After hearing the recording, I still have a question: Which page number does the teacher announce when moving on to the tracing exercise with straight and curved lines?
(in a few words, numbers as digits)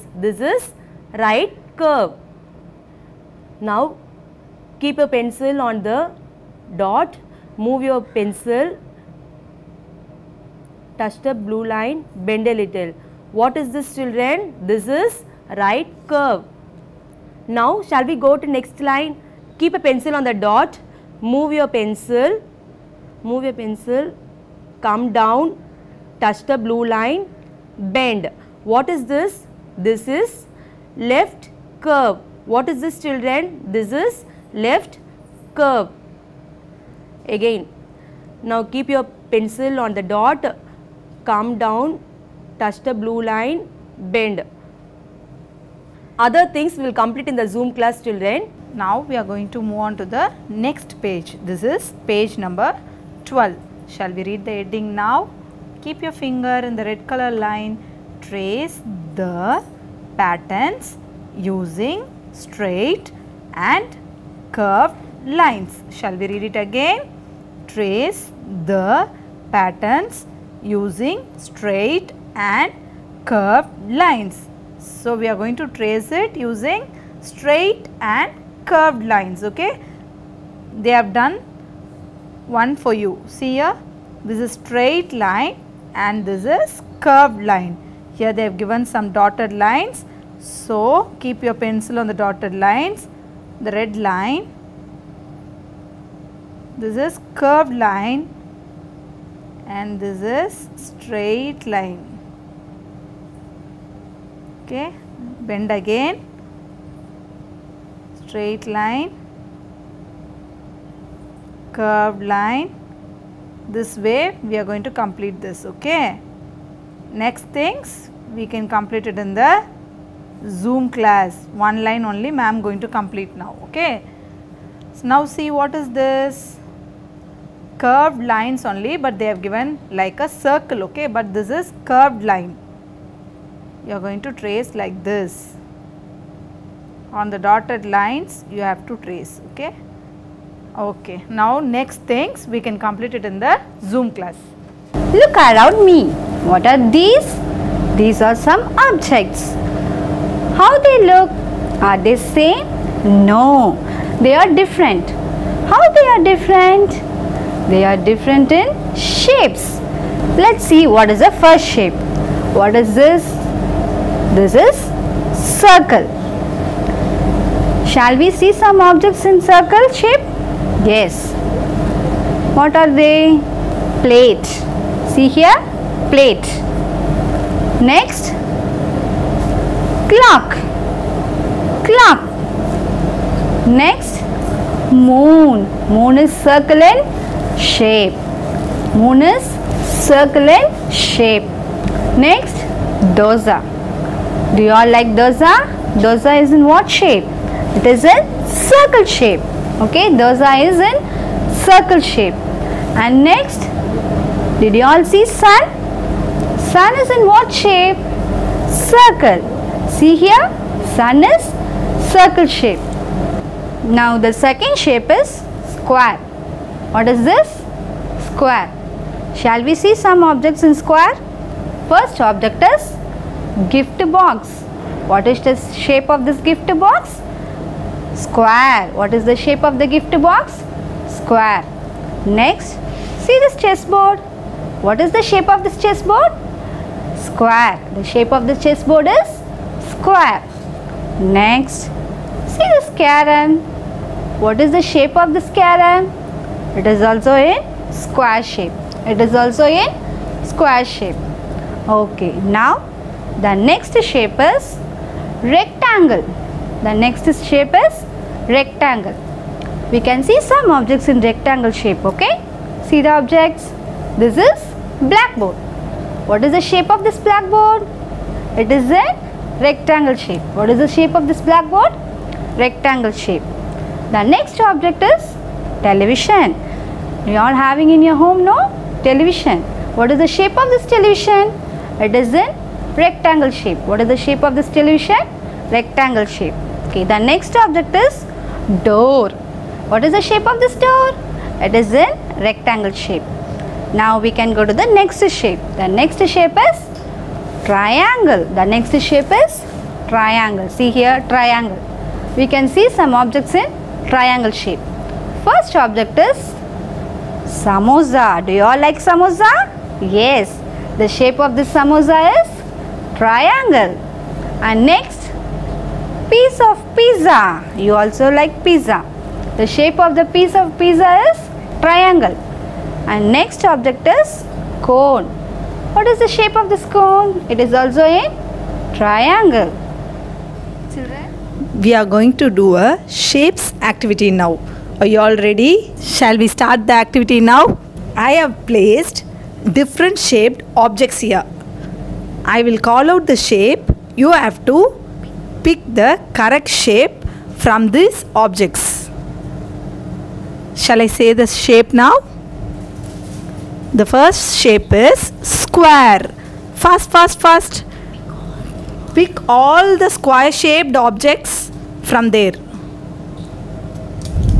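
12.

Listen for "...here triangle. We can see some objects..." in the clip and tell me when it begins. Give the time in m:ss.
5:00.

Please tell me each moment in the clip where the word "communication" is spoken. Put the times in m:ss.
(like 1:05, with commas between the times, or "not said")
not said.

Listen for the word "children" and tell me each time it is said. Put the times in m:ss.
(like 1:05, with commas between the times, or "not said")
0:13, 0:33, 5:30.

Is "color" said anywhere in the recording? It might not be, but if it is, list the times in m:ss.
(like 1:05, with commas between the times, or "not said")
0:57.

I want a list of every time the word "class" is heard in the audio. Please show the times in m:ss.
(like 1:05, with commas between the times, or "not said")
0:47, 2:00, 2:24.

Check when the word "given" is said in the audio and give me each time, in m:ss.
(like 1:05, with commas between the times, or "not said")
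1:28, 2:09.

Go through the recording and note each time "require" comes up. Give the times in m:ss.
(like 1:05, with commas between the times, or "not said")
not said.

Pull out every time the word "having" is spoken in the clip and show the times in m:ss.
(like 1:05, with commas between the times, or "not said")
4:37.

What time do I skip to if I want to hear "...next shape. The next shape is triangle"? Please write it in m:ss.
4:54.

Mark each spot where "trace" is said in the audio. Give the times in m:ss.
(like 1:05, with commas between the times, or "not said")
0:58, 1:07, 1:15, 2:14, 2:19.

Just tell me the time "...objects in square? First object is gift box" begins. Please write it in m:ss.
3:40.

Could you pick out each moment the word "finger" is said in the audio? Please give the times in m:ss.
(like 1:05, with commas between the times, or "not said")
0:56.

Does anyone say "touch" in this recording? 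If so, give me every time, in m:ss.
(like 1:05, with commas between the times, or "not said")
0:10, 0:26, 0:42.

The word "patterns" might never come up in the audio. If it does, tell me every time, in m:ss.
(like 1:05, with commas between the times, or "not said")
1:00, 1:09.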